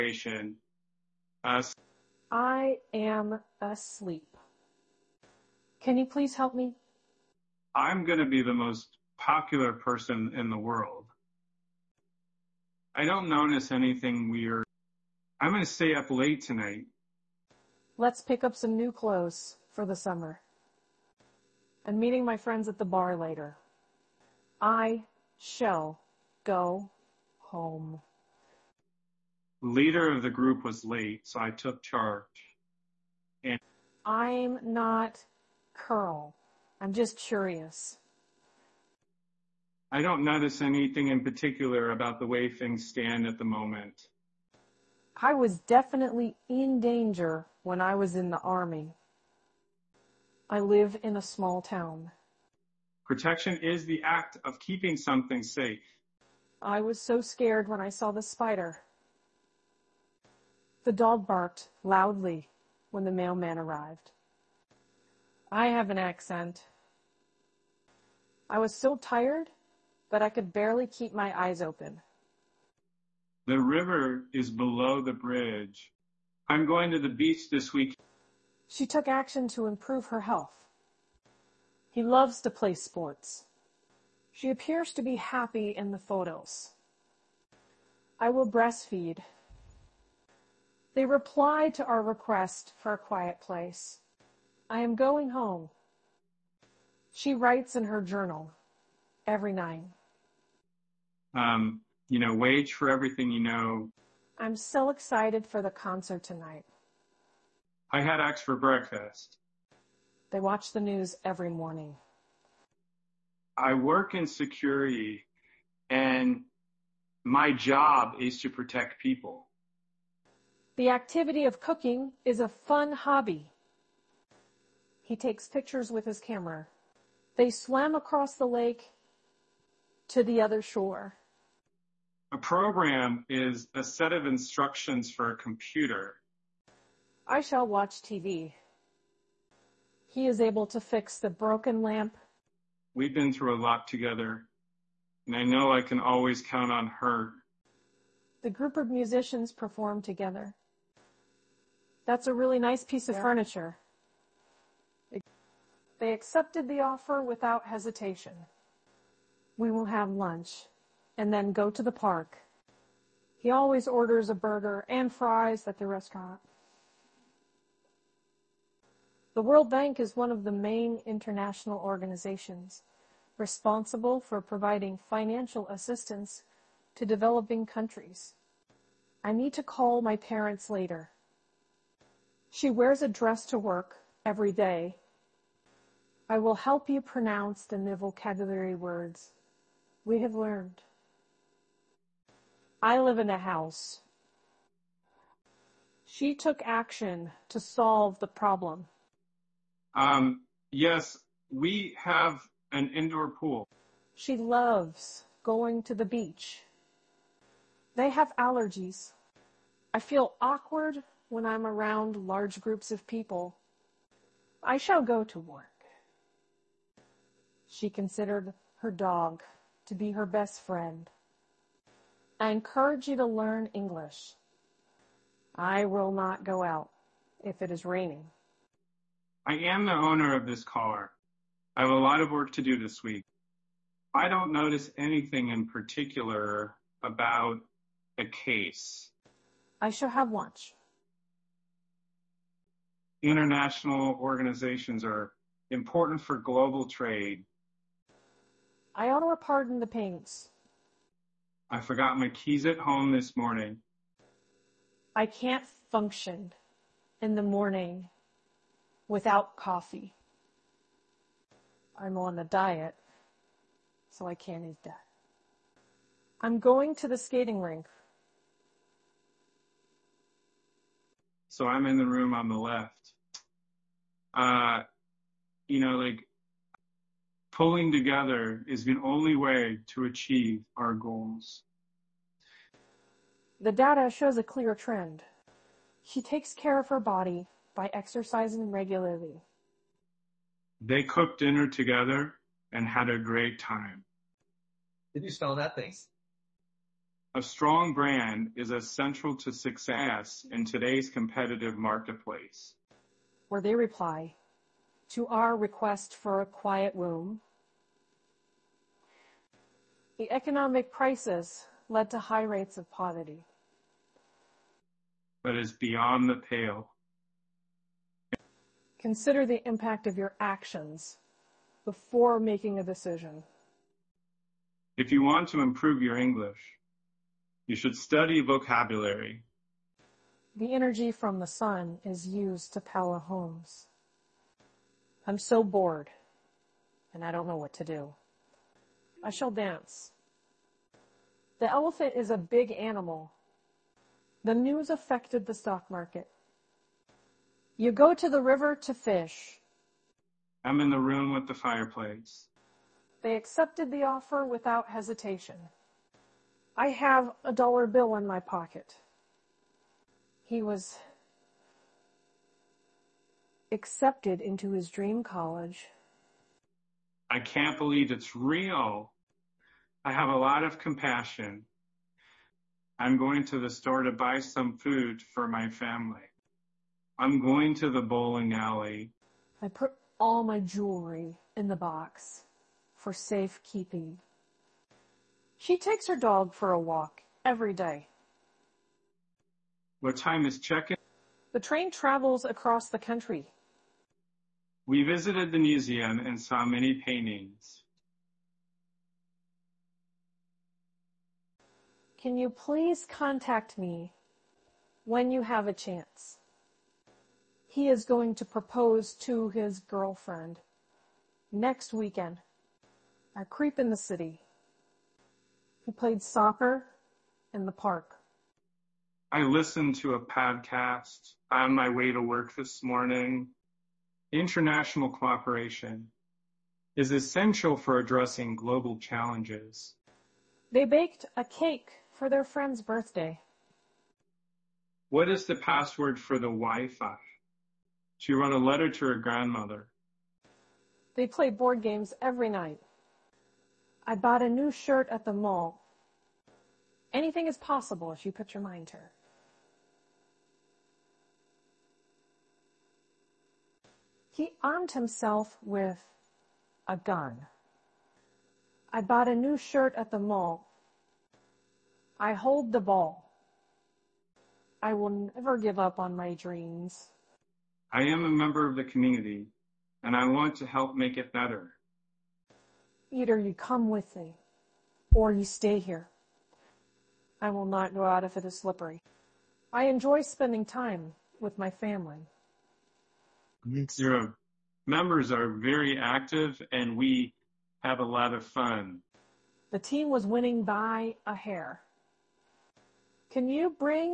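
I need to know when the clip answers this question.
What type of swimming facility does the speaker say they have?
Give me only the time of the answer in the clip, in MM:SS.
03:21.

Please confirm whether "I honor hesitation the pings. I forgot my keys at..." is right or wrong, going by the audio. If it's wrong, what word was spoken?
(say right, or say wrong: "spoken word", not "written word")
wrong: "pardon", not "hesitation".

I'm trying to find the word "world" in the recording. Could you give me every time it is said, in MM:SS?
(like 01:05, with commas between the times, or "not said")
00:10, 02:49.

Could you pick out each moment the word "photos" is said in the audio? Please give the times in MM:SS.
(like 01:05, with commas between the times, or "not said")
01:25.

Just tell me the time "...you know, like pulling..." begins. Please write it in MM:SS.
04:35.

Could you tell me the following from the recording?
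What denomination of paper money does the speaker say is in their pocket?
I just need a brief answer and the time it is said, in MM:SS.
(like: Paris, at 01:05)
a dollar bill, at 05:57.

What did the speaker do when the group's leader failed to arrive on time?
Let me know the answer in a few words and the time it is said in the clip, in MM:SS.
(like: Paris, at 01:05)
took charge, at 00:31.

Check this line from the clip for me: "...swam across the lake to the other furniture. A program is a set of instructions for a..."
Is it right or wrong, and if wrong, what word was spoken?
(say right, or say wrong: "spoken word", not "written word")
wrong: "shore", not "furniture".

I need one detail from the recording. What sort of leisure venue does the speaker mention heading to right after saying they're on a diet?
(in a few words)
skating rink.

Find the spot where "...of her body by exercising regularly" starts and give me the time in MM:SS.
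04:46.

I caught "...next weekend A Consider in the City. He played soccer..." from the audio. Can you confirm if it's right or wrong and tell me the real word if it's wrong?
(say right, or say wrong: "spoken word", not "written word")
wrong: "Creep", not "Consider".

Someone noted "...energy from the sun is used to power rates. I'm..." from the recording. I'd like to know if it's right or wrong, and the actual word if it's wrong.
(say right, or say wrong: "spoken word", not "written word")
wrong: "homes", not "rates".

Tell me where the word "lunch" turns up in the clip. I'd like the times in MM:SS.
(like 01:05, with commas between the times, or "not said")
02:40, 04:00.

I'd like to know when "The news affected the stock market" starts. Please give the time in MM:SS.
05:44.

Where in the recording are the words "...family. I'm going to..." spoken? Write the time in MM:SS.
06:15.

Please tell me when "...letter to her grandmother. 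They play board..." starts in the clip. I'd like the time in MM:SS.
07:18.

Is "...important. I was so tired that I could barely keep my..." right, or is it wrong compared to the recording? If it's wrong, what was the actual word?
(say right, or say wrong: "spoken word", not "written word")
wrong: "accent", not "important".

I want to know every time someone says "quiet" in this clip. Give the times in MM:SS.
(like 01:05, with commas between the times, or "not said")
01:32, 05:06.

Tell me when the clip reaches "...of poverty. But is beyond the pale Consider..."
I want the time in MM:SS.
05:12.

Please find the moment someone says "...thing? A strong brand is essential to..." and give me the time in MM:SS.
04:55.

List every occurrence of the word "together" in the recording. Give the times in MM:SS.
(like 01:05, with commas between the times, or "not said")
02:23, 02:30, 04:37, 04:51.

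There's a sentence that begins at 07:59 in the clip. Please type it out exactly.
I enjoy spending time with my family.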